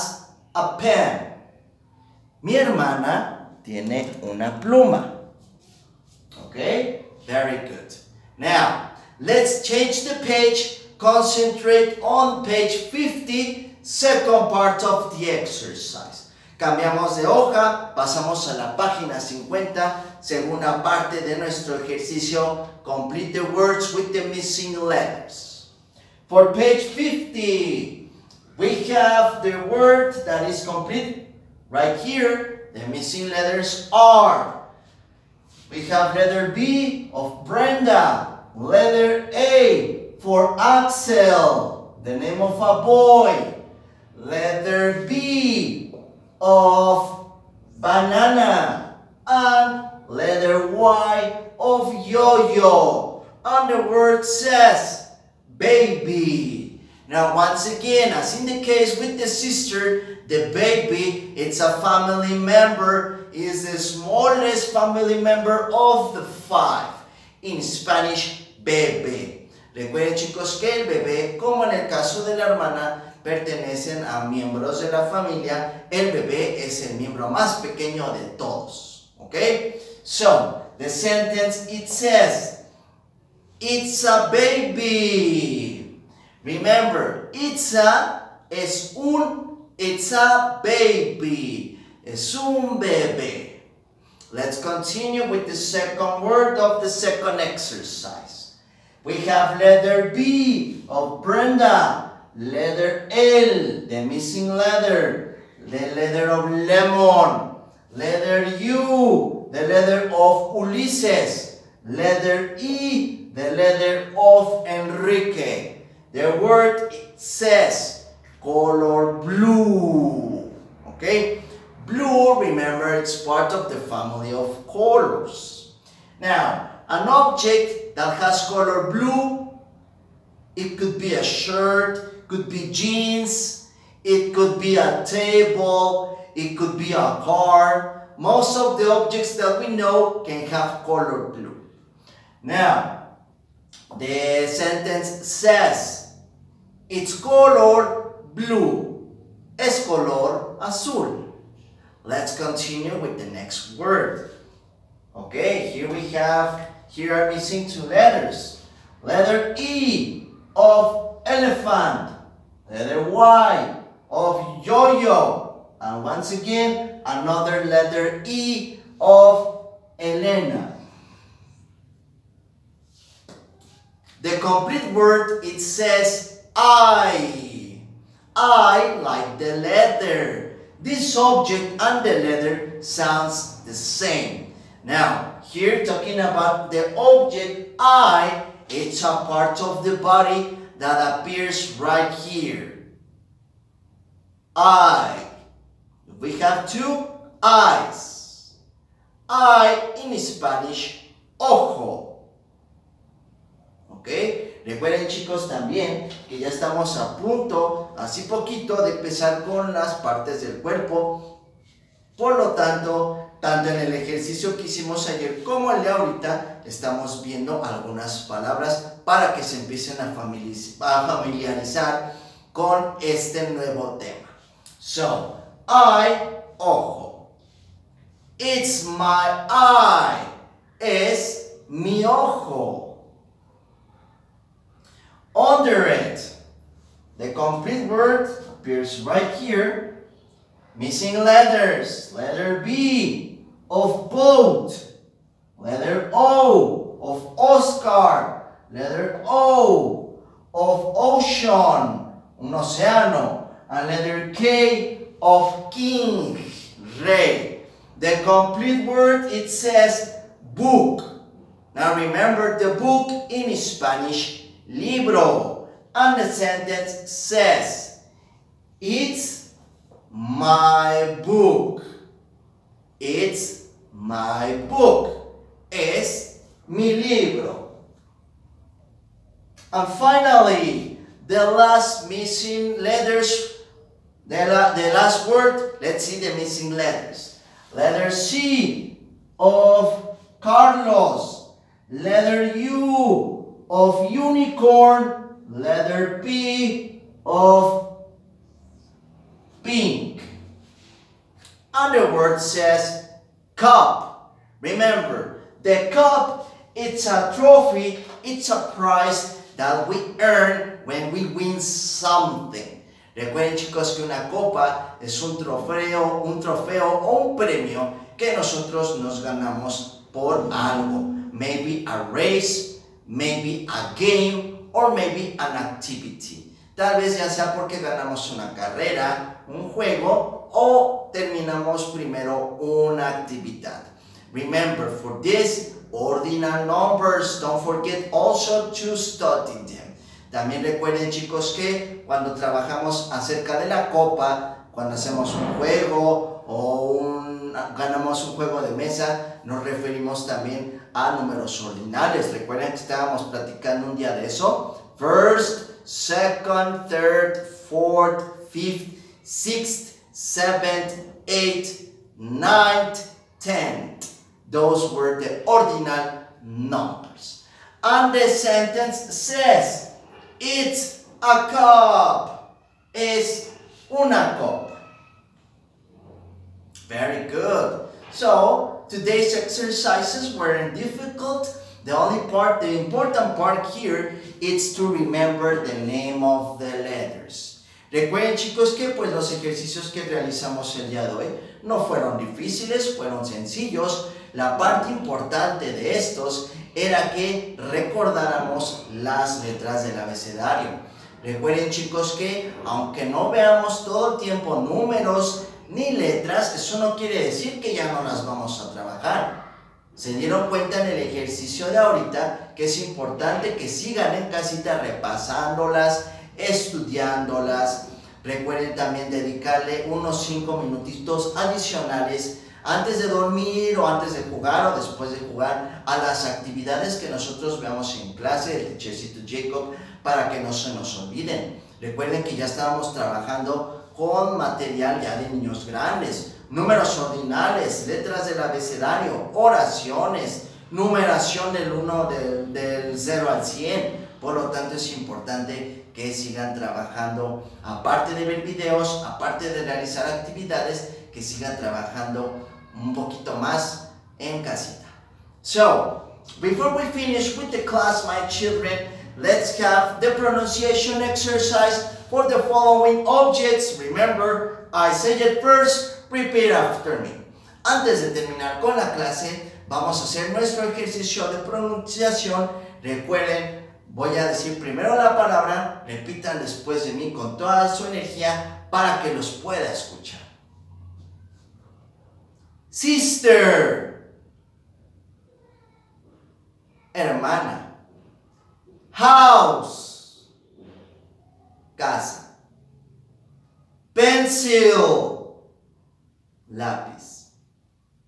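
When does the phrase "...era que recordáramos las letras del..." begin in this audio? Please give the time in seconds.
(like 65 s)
396 s.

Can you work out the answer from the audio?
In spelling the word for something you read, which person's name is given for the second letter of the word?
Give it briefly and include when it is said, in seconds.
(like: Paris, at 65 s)
Oscar, at 247 s.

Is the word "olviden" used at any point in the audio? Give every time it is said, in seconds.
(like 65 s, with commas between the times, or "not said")
430 s.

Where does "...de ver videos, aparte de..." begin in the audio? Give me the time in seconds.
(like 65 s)
448 s.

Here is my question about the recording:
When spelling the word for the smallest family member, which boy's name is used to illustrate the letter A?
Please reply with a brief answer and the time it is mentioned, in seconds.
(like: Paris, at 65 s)
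Axel, at 40 s.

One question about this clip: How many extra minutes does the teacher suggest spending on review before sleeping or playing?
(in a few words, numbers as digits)
5.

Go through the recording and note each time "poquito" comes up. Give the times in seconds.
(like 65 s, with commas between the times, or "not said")
208 s, 452 s.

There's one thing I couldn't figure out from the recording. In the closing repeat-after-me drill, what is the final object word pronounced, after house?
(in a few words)
Pencil.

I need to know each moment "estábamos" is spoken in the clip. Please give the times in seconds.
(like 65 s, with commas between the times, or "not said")
352 s, 432 s.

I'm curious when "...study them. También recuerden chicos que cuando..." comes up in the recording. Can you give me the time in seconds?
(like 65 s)
338 s.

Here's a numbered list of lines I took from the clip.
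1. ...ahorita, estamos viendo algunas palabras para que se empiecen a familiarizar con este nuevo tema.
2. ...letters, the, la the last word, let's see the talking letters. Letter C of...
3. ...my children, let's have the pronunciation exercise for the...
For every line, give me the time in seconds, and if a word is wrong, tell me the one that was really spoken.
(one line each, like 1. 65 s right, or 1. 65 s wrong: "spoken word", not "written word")
1. 215 s right
2. 282 s wrong: "missing", not "talking"
3. 458 s right.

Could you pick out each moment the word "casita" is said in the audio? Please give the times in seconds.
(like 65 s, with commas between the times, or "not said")
414 s, 454 s.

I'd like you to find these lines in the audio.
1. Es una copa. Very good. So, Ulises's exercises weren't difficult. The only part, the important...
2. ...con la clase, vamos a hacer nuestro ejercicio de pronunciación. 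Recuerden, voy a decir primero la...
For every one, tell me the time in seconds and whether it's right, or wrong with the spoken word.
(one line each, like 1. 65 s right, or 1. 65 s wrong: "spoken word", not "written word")
1. 372 s wrong: "Today", not "Ulises"
2. 468 s right.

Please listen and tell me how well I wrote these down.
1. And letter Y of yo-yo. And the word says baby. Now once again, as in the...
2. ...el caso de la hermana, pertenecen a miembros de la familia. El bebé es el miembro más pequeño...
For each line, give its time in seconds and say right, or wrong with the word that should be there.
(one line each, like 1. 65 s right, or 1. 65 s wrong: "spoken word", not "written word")
1. 49 s right
2. 71 s right.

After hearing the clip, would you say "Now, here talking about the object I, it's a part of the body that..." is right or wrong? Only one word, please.
right.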